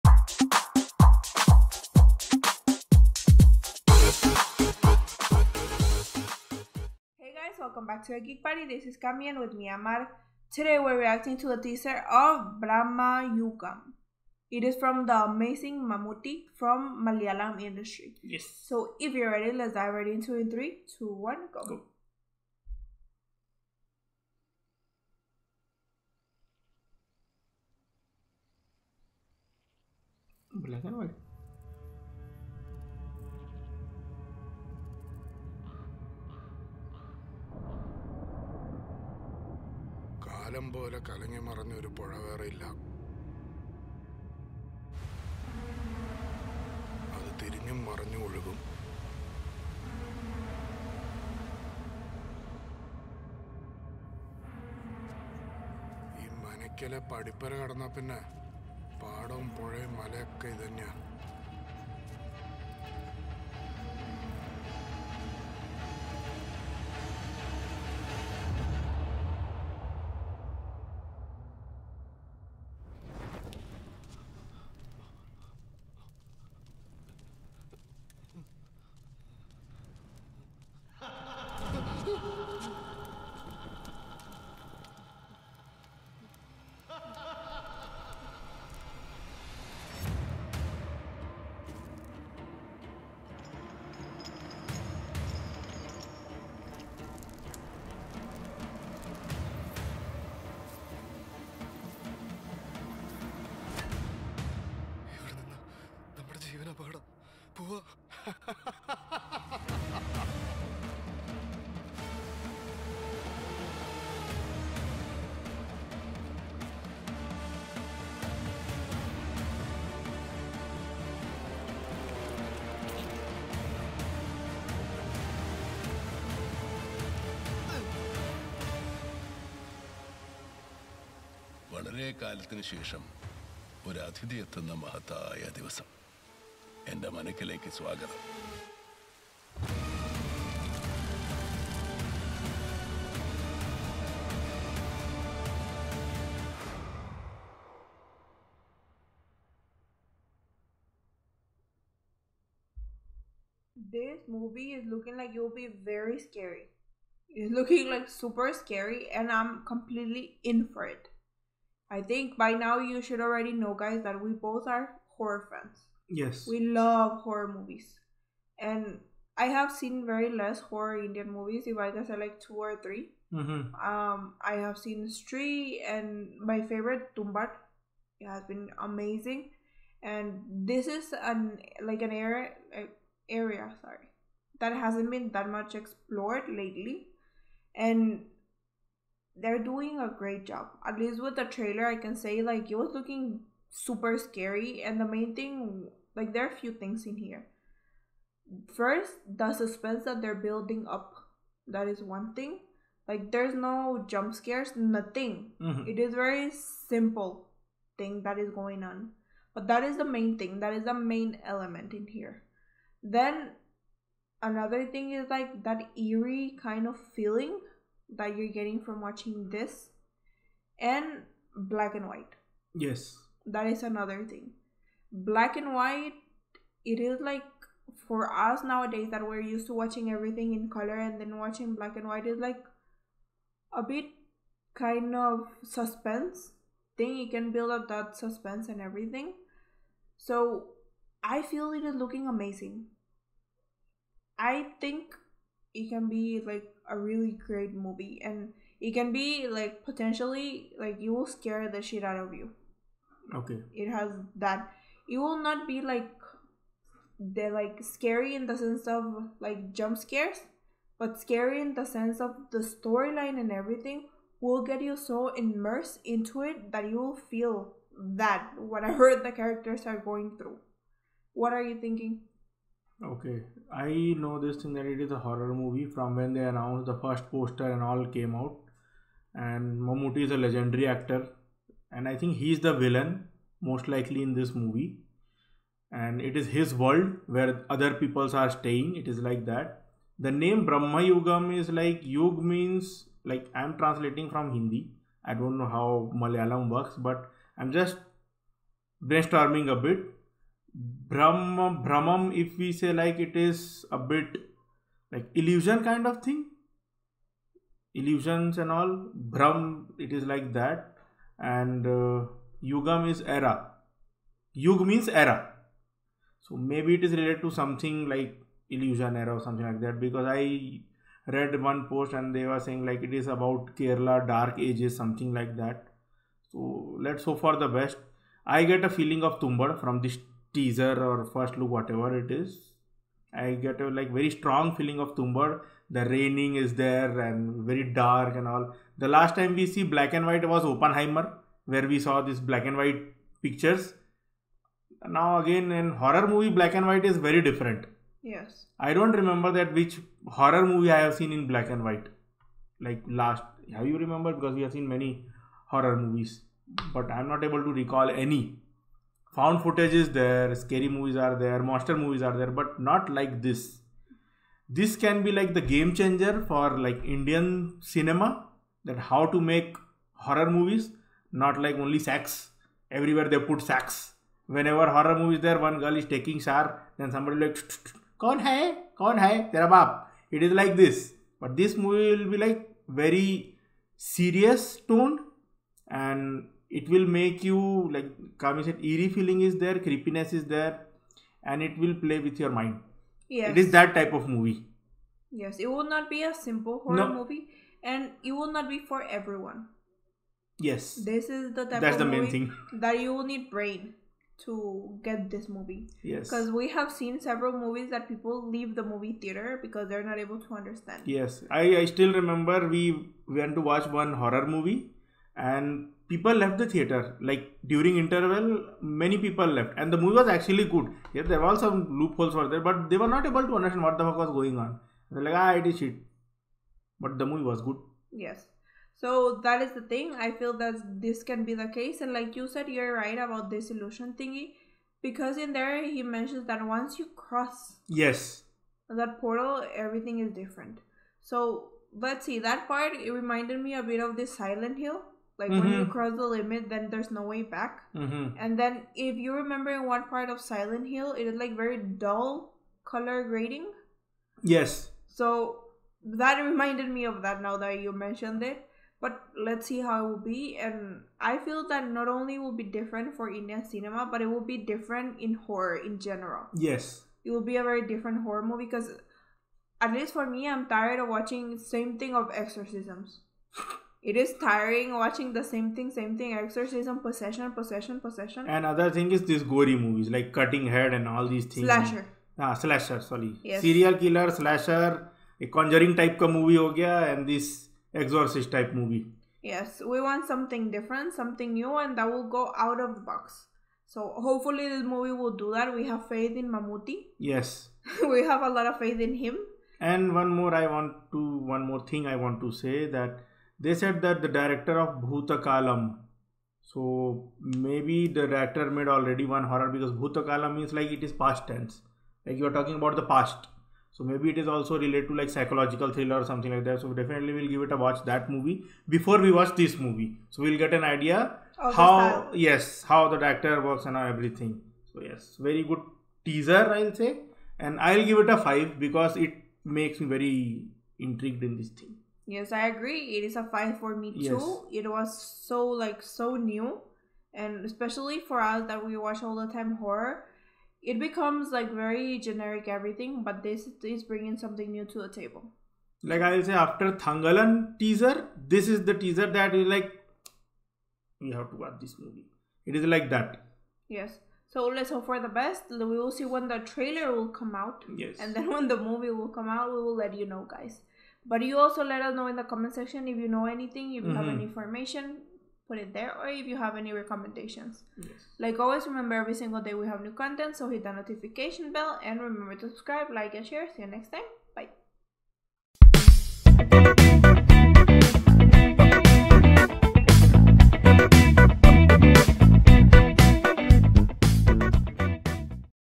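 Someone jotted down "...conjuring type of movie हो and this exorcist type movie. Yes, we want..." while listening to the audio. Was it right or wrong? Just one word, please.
right.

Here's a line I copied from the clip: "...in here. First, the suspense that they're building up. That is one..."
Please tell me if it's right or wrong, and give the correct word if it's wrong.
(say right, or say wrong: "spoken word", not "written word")
right.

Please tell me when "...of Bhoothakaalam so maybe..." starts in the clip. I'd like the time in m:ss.
8:24.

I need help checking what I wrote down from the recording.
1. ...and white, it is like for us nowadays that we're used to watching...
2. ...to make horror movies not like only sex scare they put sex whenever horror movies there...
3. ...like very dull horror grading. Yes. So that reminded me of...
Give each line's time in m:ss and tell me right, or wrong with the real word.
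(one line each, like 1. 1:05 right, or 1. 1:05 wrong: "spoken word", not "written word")
1. 3:45 right
2. 6:09 wrong: "everywhere", not "scare"
3. 7:31 wrong: "color", not "horror".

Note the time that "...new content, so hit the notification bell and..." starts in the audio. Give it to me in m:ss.
9:30.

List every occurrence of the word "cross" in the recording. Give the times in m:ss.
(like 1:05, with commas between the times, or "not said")
7:17, 7:25.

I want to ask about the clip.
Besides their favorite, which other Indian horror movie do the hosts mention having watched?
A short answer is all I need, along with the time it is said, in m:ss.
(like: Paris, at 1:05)
Stree, at 2:54.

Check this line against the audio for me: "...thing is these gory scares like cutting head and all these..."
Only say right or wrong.
wrong.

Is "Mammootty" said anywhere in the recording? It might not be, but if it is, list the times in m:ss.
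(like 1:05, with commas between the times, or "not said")
0:15, 4:39, 8:16.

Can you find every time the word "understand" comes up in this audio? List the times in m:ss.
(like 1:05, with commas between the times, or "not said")
6:50, 7:03.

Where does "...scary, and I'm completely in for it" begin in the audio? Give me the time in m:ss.
2:38.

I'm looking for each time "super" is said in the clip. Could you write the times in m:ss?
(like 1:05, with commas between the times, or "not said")
2:38, 3:13.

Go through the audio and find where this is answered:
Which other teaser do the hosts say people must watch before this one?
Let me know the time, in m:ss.
9:06.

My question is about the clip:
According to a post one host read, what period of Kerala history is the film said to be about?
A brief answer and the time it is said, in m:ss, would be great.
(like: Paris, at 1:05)
Kerala dark ages, at 5:23.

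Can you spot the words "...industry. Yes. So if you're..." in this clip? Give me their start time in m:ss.
0:17.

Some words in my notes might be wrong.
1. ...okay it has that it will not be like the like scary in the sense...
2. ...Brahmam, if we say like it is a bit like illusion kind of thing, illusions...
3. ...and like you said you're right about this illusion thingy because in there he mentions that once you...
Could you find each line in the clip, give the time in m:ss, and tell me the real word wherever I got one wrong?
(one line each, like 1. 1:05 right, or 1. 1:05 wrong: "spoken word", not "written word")
1. 4:13 right
2. 5:01 right
3. 7:12 right.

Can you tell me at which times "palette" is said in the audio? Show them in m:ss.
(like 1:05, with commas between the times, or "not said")
not said.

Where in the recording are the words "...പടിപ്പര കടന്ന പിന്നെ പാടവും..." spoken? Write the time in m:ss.
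0:57.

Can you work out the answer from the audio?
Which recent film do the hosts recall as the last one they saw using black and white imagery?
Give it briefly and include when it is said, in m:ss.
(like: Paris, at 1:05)
Oppenheimer, at 5:40.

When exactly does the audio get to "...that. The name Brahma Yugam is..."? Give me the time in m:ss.
4:49.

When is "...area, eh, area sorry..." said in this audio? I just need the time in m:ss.
3:02.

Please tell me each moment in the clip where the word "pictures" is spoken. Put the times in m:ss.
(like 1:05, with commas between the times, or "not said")
5:43.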